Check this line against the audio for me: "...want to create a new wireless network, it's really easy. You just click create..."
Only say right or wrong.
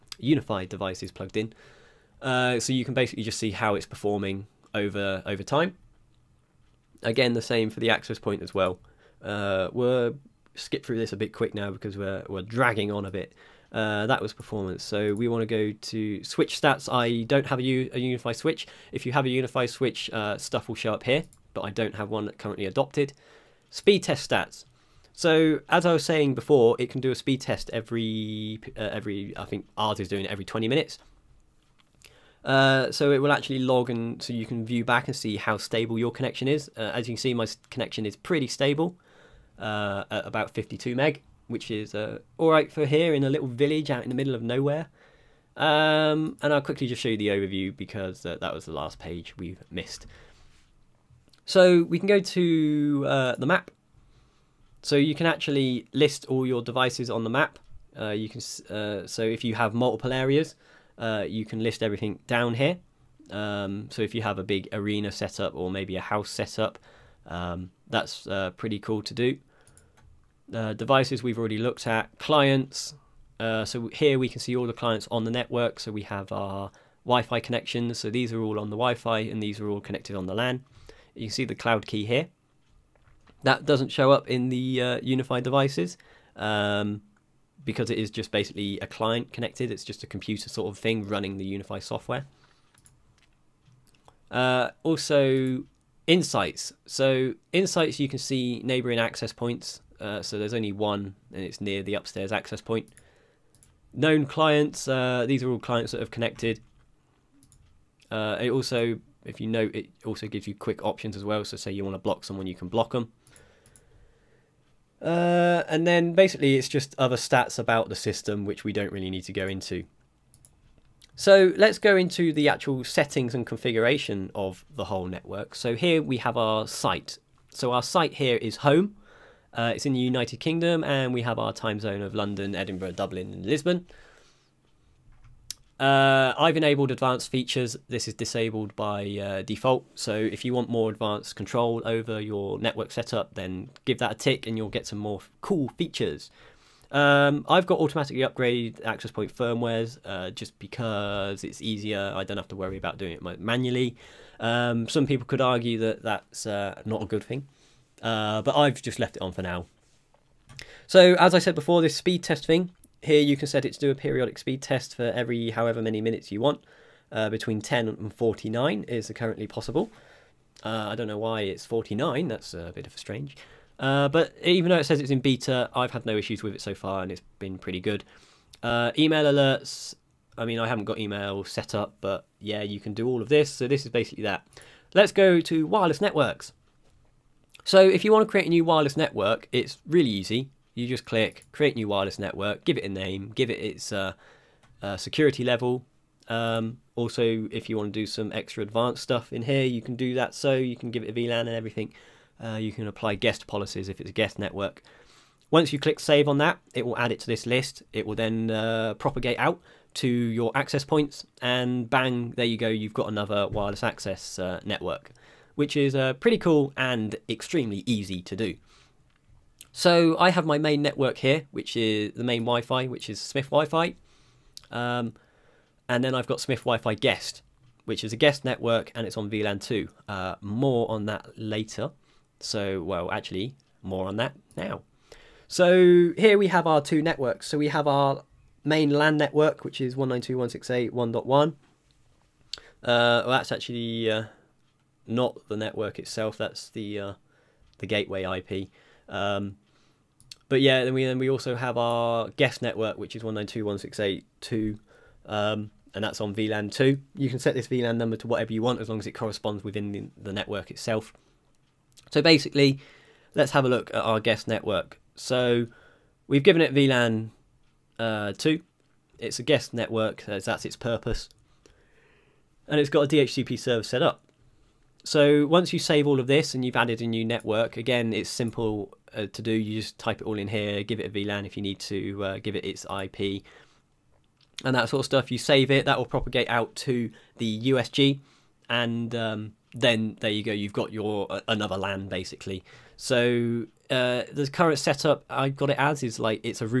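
right.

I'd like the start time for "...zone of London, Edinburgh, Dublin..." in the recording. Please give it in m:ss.
2:11.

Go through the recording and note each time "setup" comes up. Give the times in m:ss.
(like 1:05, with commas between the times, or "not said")
2:22, 4:54.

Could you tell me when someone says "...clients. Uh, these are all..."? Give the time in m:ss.
1:44.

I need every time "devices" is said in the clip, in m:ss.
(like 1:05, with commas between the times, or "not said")
0:00, 0:56, 1:10, 1:25.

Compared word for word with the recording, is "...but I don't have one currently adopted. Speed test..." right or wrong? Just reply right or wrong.
right.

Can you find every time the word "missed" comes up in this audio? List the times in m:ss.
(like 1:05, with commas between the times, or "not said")
0:49.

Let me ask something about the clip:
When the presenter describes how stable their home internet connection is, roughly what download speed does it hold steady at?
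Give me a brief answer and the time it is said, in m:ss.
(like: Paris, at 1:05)
52 meg, at 0:40.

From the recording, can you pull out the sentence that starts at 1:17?
So these are all on the Wi-Fi and these are all connected on the LAN.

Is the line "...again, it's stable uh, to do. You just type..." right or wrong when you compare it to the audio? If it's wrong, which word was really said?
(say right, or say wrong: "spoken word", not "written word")
wrong: "simple", not "stable".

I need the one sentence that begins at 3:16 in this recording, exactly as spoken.
Um, also, if you want to do some extra advanced stuff in here, you can do that.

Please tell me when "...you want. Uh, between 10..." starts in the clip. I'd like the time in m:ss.
2:46.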